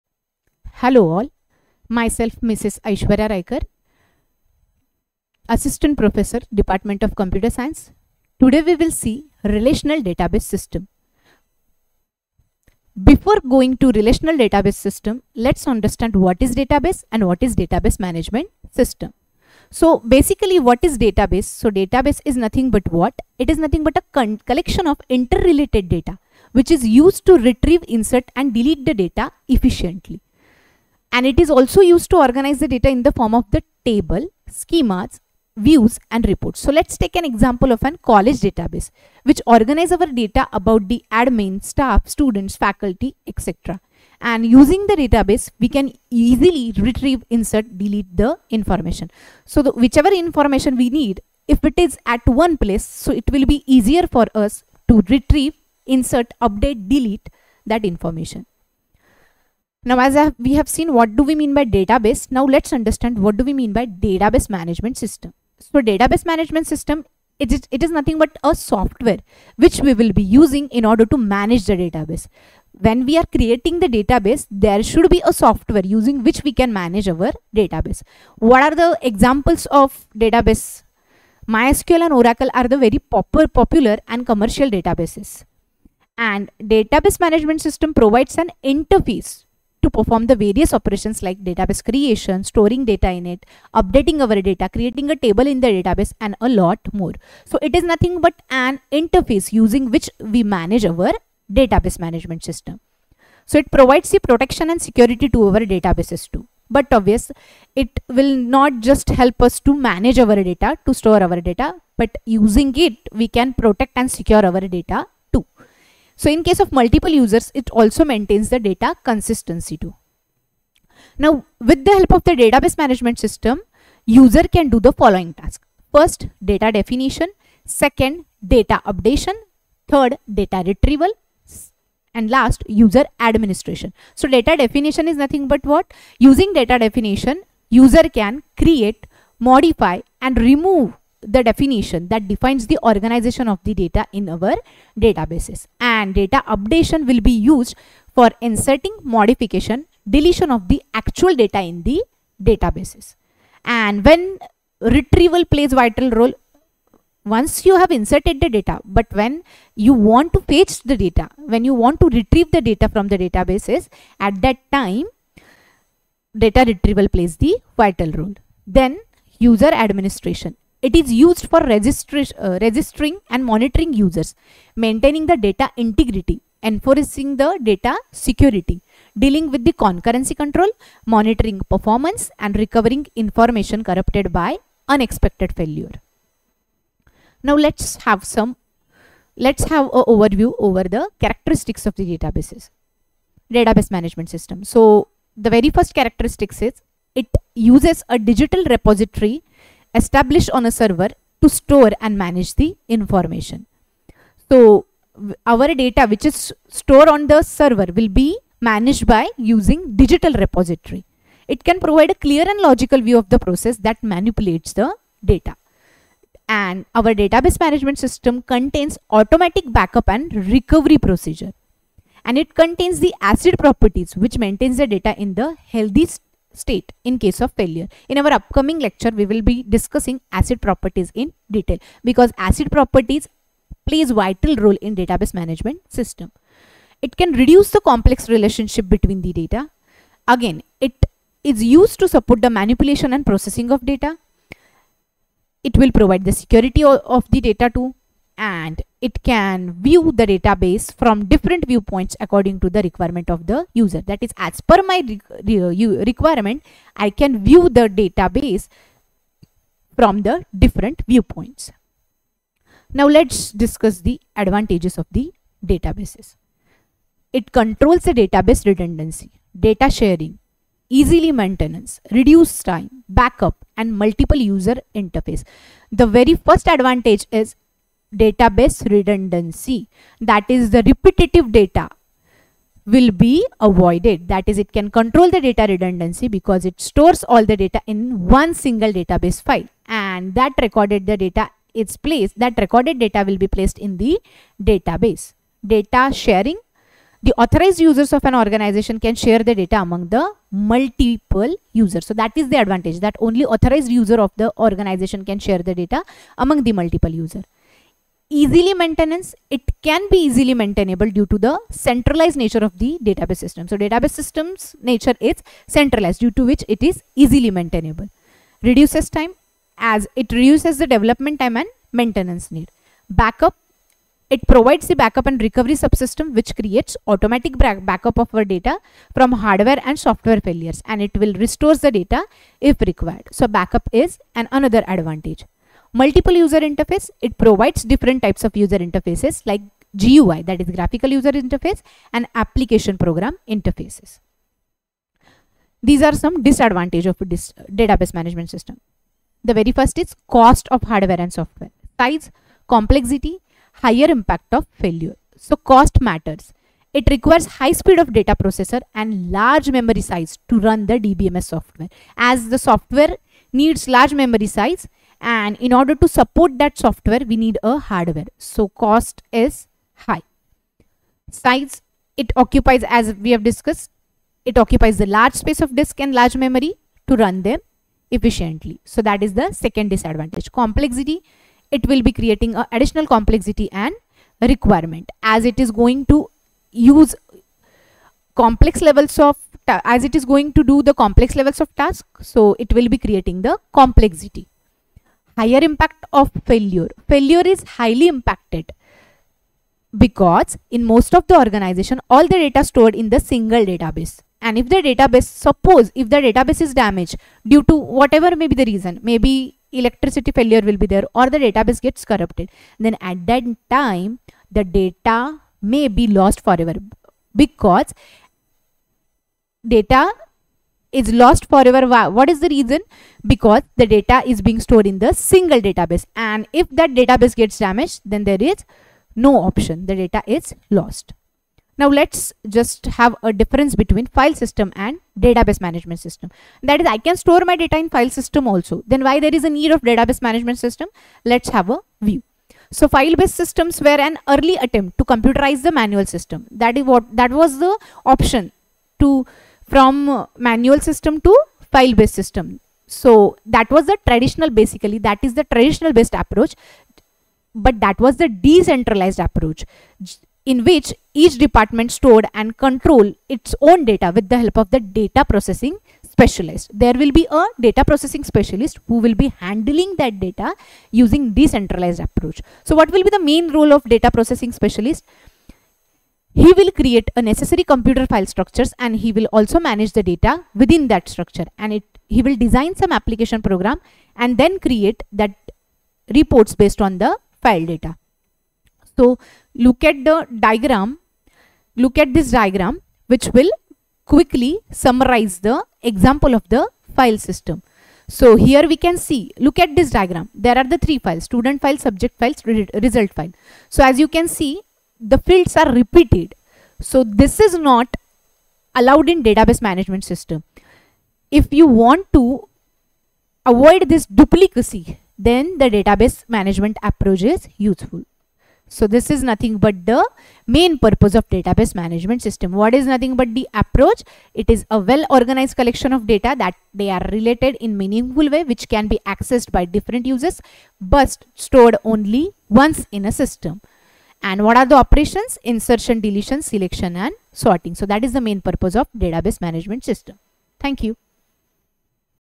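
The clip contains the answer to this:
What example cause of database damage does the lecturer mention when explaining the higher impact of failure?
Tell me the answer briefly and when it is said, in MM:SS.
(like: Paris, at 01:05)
Electricity failure, at 06:49.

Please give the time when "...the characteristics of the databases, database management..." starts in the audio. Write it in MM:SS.
03:10.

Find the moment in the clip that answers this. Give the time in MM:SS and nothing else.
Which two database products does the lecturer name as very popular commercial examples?
01:21.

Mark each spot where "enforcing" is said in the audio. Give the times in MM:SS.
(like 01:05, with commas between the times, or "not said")
02:56.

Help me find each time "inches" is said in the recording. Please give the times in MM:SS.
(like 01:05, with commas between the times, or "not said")
not said.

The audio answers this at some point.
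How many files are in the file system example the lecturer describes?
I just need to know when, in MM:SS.
08:20.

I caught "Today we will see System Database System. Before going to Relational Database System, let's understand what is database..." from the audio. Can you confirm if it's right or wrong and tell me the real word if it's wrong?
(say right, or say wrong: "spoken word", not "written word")
wrong: "Relational", not "System".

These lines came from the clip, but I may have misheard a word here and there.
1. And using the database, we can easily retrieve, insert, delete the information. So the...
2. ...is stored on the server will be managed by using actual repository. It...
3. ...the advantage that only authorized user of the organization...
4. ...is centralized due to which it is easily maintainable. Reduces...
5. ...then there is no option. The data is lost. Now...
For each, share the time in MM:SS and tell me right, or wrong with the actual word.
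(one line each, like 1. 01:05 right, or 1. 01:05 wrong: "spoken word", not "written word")
1. 00:44 right
2. 03:26 wrong: "digital", not "actual"
3. 05:02 right
4. 05:15 right
5. 07:08 right.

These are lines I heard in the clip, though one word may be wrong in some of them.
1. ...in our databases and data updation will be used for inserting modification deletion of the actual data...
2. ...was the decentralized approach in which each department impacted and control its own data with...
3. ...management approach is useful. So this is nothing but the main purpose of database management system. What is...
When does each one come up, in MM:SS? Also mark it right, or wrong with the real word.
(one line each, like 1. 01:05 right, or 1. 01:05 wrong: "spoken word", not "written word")
1. 02:24 right
2. 07:38 wrong: "stored", not "impacted"
3. 08:36 right.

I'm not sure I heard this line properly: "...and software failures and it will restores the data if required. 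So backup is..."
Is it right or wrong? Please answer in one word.
right.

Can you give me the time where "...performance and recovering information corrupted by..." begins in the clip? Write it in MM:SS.
03:01.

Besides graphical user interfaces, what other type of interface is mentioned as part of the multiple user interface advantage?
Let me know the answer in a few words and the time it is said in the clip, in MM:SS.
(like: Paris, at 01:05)
Application program interfaces, at 05:42.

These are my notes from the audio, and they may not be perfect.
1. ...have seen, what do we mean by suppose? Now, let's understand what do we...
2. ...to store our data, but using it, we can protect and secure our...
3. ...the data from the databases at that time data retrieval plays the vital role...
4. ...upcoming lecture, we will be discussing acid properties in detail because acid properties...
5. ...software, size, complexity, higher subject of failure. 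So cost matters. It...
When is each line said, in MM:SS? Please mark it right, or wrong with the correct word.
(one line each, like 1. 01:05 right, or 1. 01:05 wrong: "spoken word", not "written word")
1. 01:00 wrong: "database", not "suppose"
2. 01:50 right
3. 02:42 right
4. 03:48 right
5. 05:51 wrong: "impact", not "subject".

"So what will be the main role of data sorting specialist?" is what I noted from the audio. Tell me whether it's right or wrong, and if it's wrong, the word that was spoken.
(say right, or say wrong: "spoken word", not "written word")
wrong: "processing", not "sorting".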